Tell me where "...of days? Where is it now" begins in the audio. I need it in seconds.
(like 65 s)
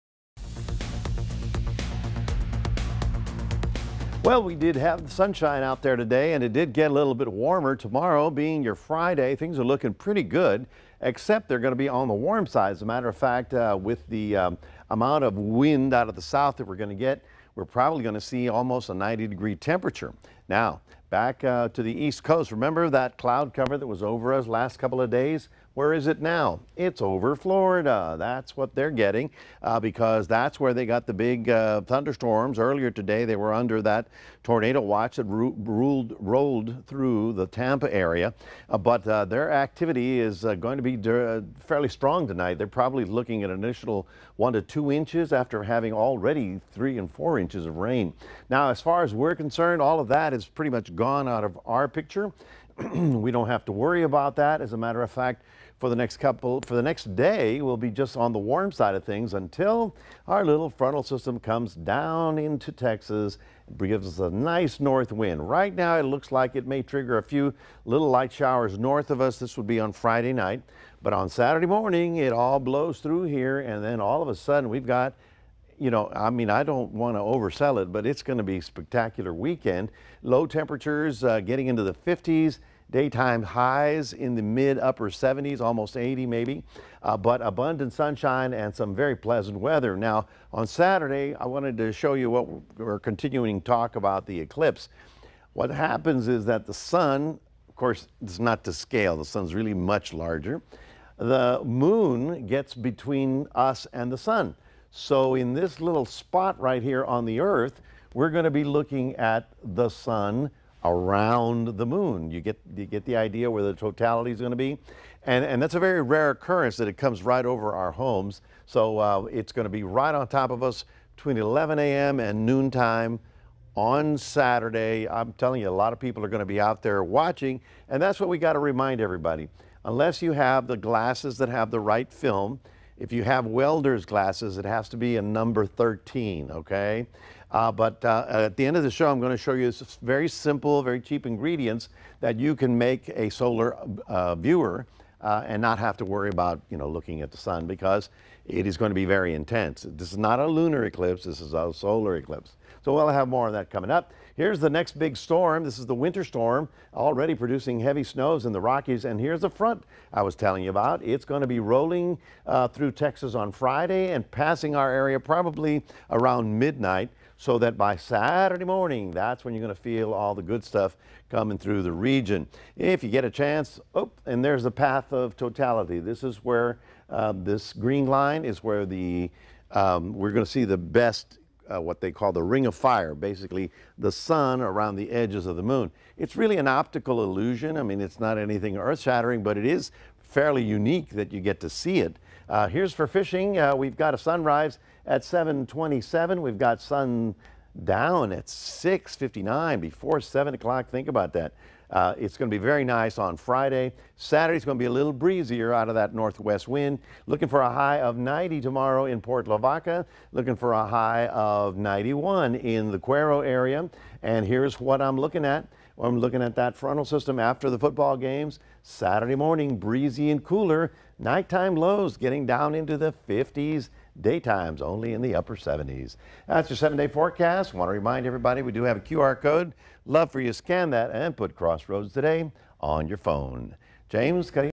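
25 s.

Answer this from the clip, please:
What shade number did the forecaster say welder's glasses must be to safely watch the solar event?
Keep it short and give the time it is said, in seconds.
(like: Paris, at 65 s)
13, at 135 s.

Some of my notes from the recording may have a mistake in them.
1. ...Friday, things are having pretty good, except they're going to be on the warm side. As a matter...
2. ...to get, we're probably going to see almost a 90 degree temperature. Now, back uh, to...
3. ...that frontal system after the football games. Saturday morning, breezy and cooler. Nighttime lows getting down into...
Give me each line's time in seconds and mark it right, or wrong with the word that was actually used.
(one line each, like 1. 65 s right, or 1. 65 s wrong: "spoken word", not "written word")
1. 8 s wrong: "looking", not "having"
2. 16 s right
3. 216 s right.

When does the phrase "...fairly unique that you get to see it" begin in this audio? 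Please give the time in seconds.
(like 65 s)
190 s.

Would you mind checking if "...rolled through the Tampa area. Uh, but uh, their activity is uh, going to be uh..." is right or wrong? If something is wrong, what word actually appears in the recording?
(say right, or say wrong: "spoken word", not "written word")
right.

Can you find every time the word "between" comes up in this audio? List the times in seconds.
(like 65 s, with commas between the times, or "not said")
102 s, 121 s.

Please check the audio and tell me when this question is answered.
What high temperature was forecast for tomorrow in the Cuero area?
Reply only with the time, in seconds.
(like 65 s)
211 s.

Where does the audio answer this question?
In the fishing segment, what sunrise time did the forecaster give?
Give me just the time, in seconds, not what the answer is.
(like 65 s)
195 s.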